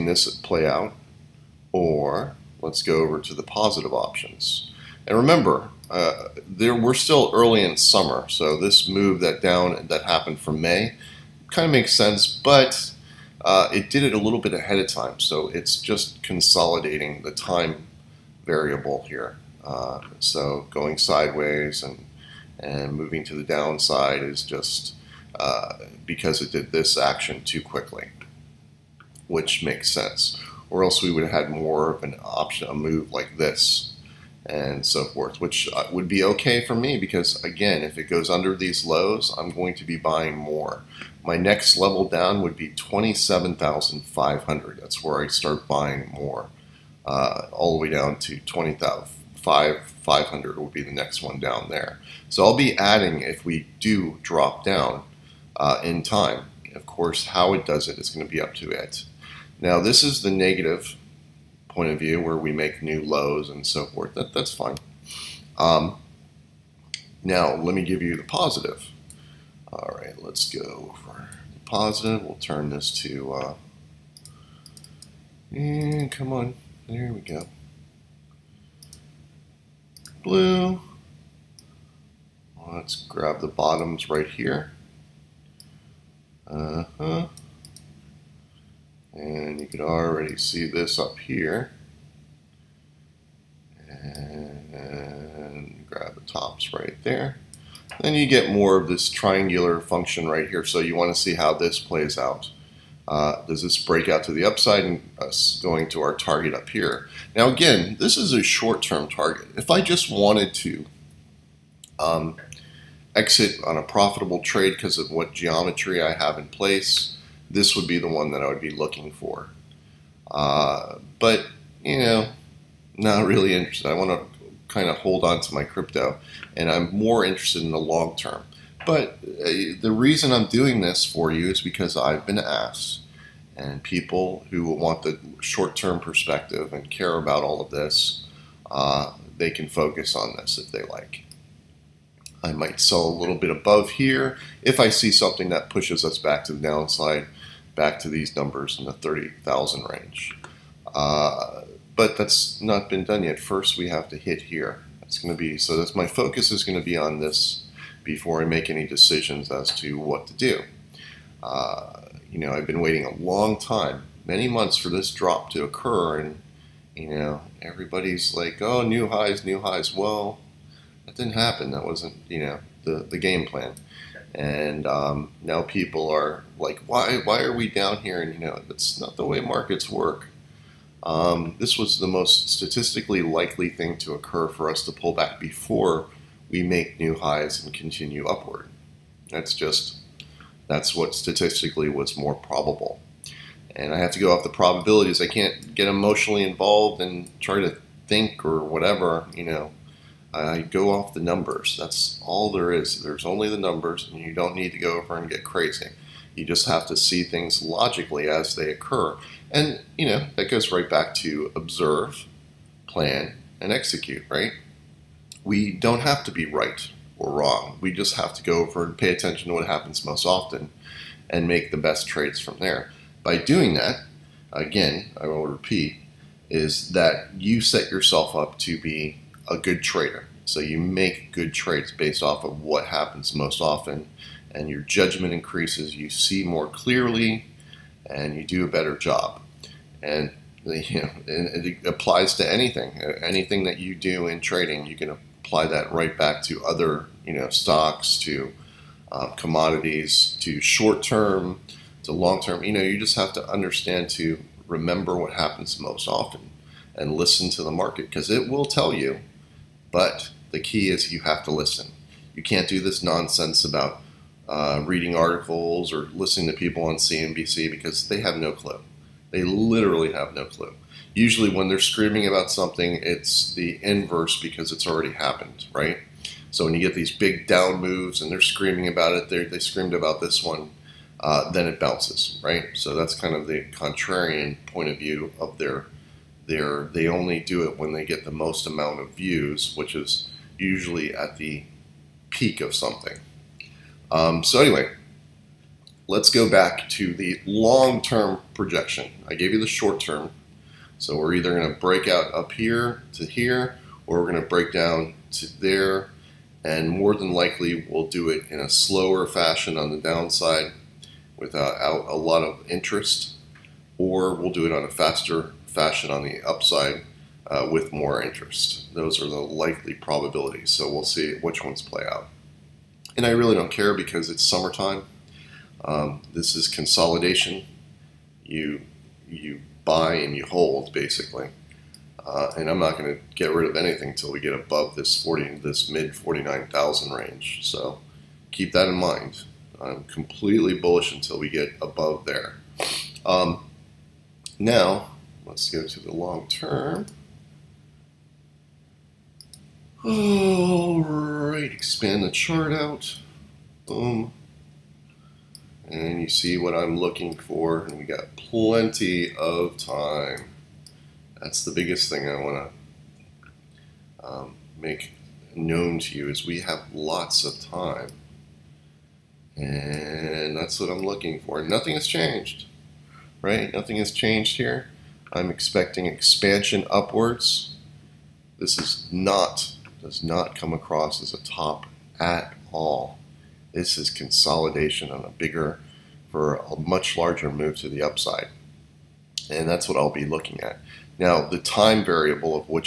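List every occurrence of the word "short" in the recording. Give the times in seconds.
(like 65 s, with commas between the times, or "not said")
108 s, 135 s, 250 s, 299 s.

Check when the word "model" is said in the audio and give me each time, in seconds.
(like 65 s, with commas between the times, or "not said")
not said.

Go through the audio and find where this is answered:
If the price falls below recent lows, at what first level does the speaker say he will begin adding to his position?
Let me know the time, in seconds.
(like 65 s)
42 s.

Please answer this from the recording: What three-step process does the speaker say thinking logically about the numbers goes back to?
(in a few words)
observe, plan, and execute.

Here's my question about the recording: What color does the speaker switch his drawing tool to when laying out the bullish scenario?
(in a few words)
Blue.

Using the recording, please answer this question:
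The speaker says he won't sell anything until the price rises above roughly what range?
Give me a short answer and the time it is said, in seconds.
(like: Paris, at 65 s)
mid 49,000, at 335 s.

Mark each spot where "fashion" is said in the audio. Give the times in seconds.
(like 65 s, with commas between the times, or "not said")
309 s, 315 s.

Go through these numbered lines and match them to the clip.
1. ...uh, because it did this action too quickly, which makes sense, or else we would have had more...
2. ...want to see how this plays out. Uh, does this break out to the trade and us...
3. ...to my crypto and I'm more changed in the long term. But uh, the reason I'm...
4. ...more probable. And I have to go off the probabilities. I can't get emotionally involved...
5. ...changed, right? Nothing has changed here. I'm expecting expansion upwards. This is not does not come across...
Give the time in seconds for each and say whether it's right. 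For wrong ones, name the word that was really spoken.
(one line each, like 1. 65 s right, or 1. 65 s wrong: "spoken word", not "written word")
1. 25 s right
2. 100 s wrong: "upside", not "trade"
3. 125 s wrong: "interested", not "changed"
4. 192 s right
5. 372 s right.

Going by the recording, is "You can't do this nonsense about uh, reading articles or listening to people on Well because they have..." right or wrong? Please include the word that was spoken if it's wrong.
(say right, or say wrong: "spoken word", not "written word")
wrong: "CNBC", not "Well".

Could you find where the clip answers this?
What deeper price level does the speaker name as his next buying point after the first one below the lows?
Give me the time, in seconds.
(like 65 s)
48 s.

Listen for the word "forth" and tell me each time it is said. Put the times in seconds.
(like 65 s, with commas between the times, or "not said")
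35 s, 63 s.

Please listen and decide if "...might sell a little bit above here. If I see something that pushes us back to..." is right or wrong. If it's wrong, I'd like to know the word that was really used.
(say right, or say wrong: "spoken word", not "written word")
right.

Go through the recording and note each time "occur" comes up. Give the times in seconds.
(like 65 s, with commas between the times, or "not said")
165 s, 184 s, 208 s.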